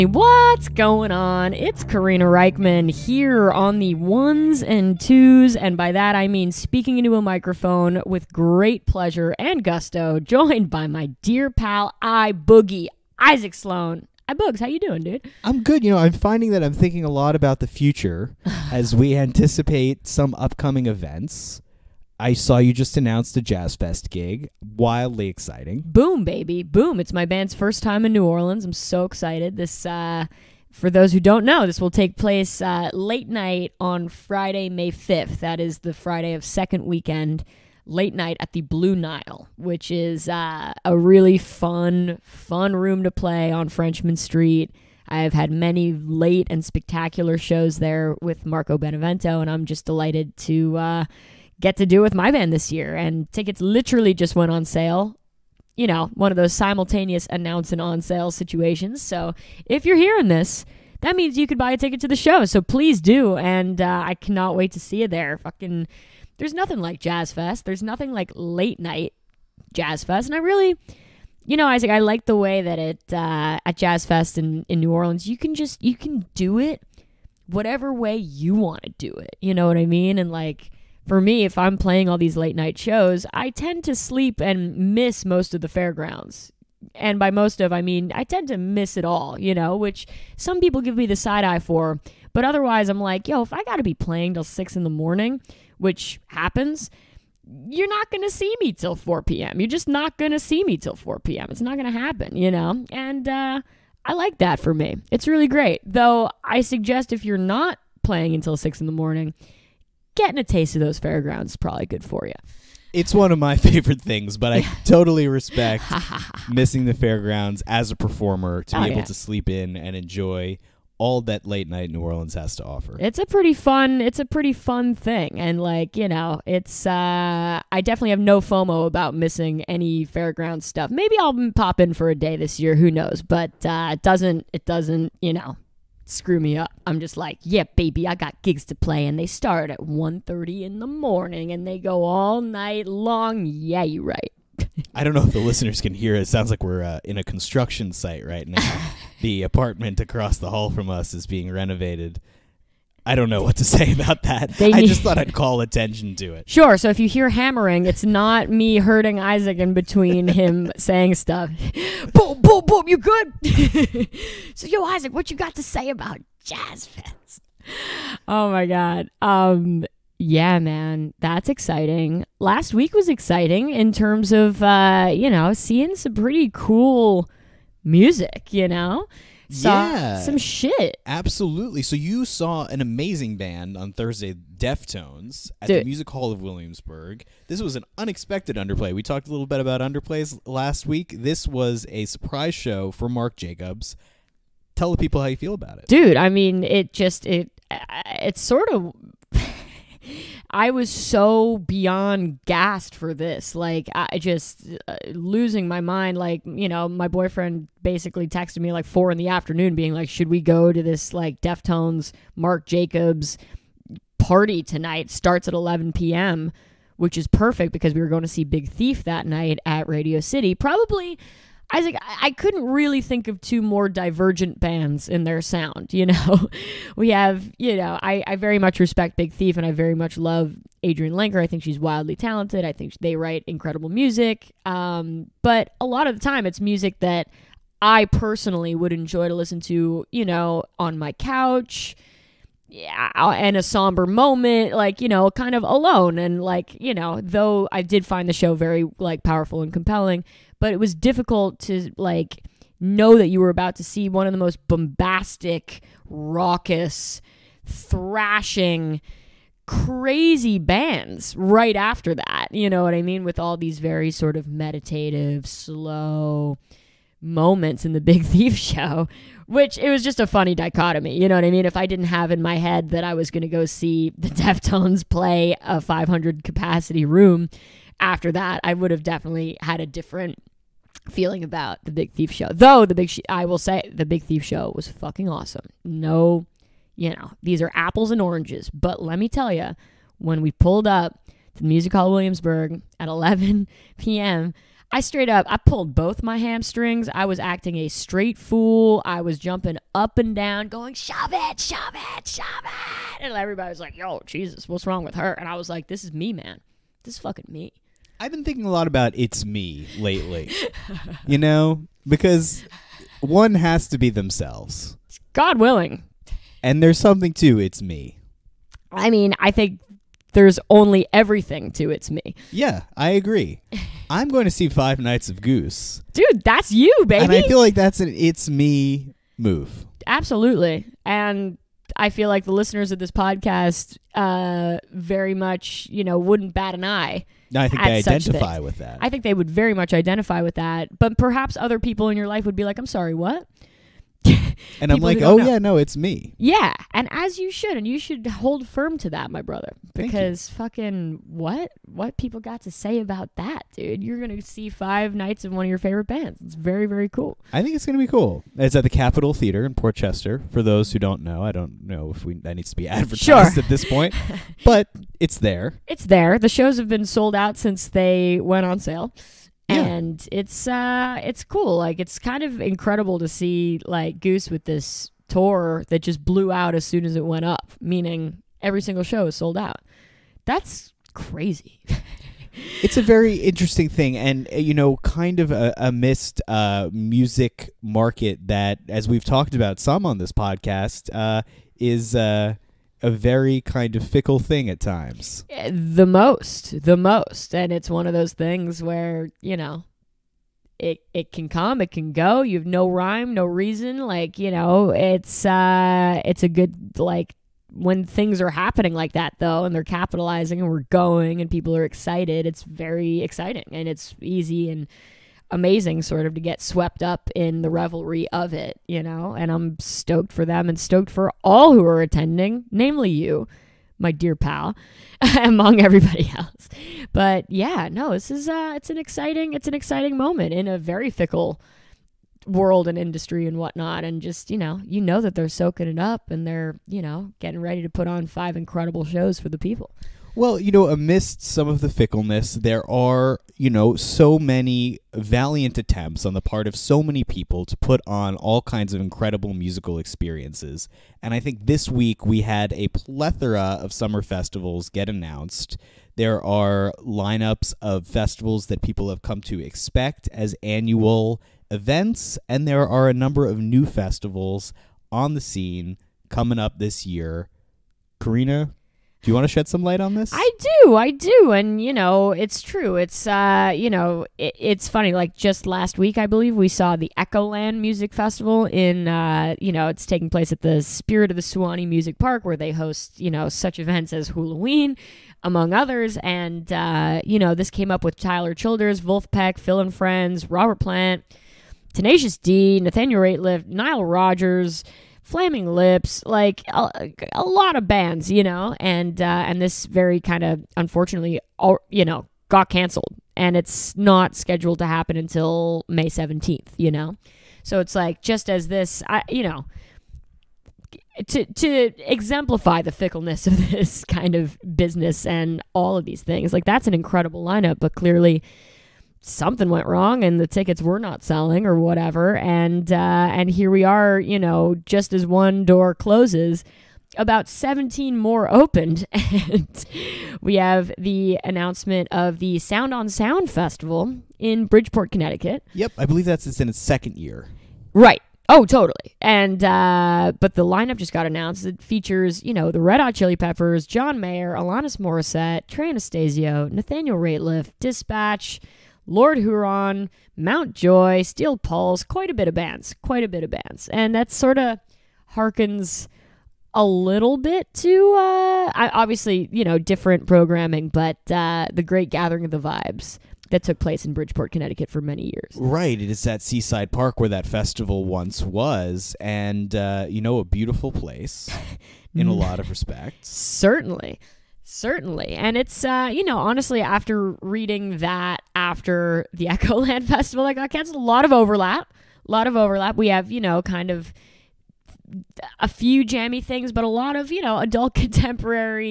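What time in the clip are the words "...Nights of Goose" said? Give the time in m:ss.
5:24.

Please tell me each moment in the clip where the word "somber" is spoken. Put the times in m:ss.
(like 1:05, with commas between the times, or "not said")
4:03.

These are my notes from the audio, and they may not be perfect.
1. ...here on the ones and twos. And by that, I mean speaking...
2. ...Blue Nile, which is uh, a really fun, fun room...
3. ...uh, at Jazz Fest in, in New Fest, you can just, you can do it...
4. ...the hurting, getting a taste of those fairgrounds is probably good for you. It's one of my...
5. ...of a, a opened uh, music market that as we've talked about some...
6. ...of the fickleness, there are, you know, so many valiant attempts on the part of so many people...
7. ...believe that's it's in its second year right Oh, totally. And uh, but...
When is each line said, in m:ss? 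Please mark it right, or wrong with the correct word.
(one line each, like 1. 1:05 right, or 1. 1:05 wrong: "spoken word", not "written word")
1. 0:02 right
2. 0:38 right
3. 1:13 wrong: "Orleans", not "Fest"
4. 1:48 wrong: "morning", not "hurting"
5. 6:25 wrong: "missed", not "opened"
6. 7:21 right
7. 8:56 right.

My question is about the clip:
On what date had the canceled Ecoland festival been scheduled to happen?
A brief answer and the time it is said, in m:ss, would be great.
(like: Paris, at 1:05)
May 17, at 8:25.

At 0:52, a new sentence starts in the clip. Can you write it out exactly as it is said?
And tickets literally just went on sale.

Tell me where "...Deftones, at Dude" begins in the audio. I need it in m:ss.
3:04.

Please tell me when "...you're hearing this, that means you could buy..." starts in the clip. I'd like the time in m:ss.
0:59.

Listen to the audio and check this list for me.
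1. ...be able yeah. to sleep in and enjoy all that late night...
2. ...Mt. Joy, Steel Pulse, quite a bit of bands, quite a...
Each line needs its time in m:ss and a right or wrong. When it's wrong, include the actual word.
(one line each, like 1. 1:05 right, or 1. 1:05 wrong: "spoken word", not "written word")
1. 1:58 right
2. 9:10 right.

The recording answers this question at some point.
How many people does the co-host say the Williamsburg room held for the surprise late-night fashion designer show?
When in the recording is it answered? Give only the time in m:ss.
4:35.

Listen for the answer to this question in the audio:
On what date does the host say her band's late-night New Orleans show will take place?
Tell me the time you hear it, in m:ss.
0:34.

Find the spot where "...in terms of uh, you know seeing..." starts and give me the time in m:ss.
2:53.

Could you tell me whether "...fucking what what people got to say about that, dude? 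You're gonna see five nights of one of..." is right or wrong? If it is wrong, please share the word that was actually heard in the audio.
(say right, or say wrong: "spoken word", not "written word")
right.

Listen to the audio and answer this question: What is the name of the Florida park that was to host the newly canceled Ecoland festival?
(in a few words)
Spirit of the Suwannee Music Park.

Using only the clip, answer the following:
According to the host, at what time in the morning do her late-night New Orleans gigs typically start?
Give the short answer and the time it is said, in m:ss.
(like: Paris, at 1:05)
1:30, at 2:19.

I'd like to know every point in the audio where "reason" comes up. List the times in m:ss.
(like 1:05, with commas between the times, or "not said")
6:43.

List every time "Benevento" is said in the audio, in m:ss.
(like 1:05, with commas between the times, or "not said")
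0:48.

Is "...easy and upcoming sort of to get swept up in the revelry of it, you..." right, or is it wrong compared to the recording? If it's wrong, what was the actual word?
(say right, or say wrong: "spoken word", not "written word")
wrong: "amazing", not "upcoming".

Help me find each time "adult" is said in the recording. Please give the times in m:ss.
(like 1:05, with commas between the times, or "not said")
9:47.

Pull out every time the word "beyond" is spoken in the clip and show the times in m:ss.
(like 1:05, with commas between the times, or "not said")
3:21.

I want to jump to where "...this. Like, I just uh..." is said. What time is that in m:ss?
3:23.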